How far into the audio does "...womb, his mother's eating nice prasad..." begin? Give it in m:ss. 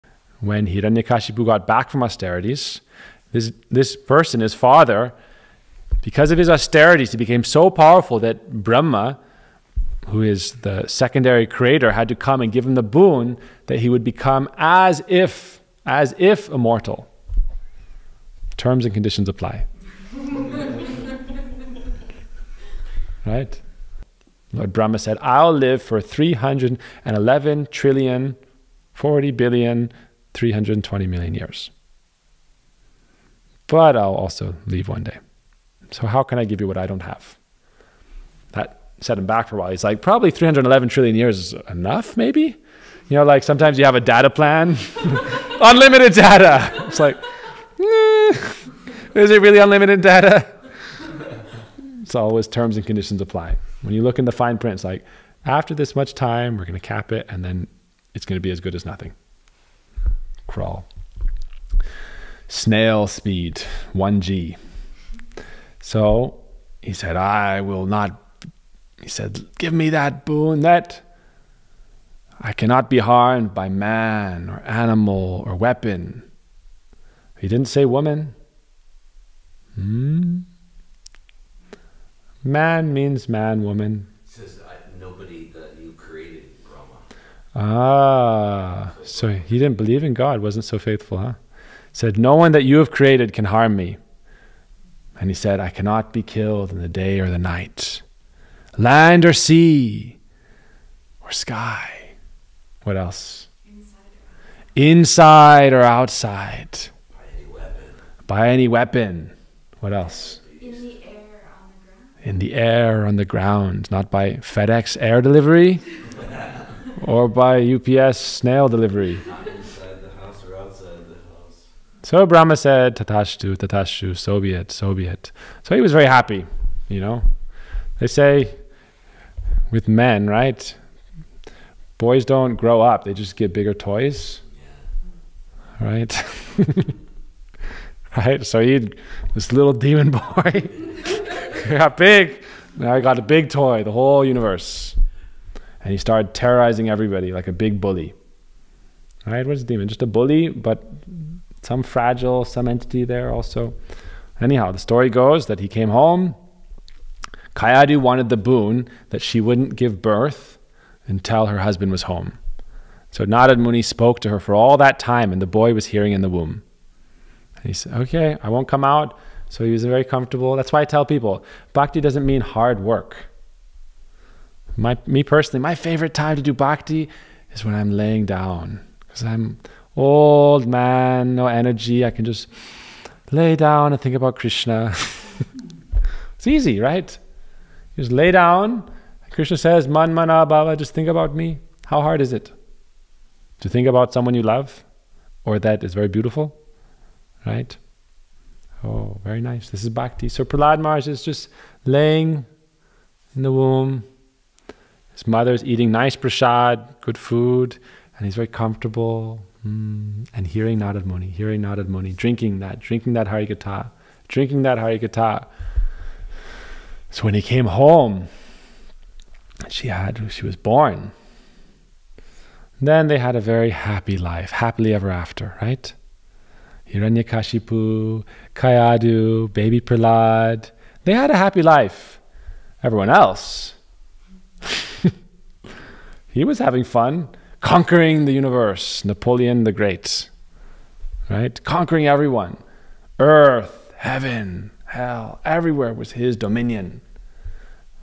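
3:23.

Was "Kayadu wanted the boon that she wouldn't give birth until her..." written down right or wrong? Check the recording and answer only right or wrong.
right.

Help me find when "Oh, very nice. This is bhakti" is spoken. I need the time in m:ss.
3:18.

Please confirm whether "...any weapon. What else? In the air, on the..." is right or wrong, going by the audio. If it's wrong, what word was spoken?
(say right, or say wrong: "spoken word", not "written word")
right.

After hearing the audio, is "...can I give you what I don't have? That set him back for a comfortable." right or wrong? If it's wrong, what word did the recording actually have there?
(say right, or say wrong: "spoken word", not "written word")
wrong: "while", not "comfortable".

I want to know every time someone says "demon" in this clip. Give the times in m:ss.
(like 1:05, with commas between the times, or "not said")
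2:19, 2:29.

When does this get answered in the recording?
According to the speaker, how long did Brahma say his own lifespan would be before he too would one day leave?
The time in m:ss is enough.
0:26.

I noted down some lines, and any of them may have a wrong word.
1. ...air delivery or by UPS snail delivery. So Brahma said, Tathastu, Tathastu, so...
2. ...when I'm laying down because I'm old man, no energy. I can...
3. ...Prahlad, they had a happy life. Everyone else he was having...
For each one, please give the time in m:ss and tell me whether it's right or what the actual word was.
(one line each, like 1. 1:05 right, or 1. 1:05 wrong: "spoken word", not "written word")
1. 1:55 right
2. 2:57 right
3. 3:49 right.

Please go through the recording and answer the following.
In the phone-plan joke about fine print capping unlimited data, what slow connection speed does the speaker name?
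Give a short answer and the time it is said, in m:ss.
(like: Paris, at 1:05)
1G, at 1:03.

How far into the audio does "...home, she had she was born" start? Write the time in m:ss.
3:37.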